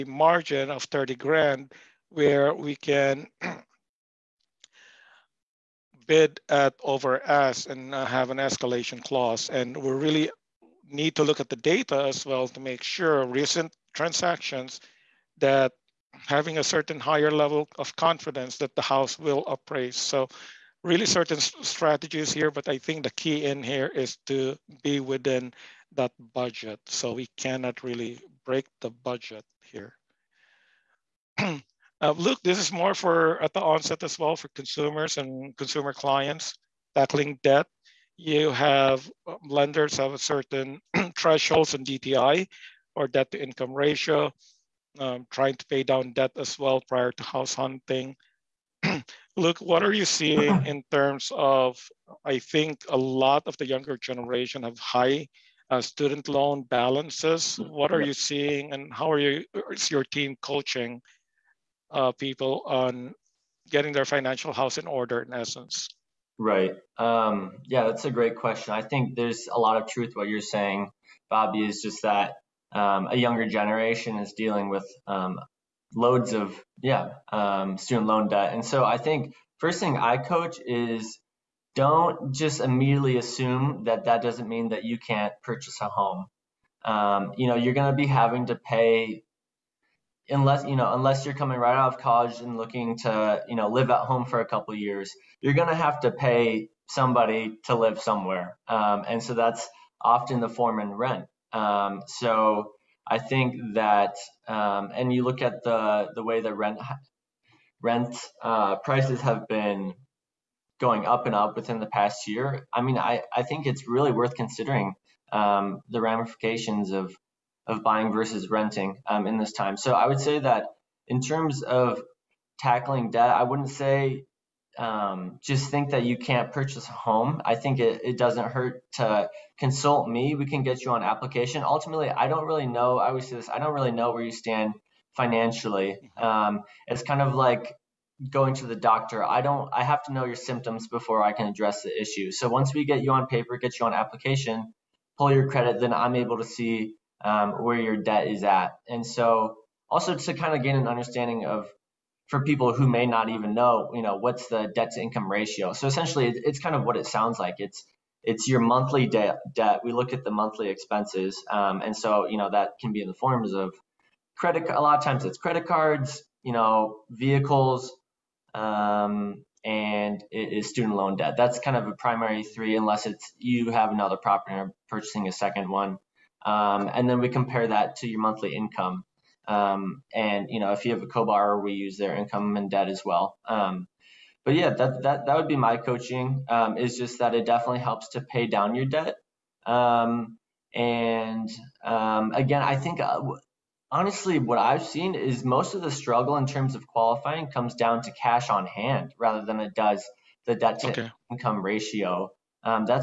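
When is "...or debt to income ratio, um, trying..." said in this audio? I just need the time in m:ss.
0:42.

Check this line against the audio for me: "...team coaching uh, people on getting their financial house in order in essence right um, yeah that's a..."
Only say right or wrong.
right.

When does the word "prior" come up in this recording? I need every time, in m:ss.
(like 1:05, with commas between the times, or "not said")
0:46.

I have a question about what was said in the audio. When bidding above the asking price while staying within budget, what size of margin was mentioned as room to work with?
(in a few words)
30 grand.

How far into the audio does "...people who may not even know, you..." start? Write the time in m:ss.
2:32.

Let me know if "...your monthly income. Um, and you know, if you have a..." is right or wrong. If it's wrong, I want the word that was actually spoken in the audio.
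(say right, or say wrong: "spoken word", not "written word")
right.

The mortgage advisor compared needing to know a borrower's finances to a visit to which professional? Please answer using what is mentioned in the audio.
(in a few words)
the doctor.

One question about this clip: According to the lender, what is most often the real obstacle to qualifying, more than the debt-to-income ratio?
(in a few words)
cash on hand.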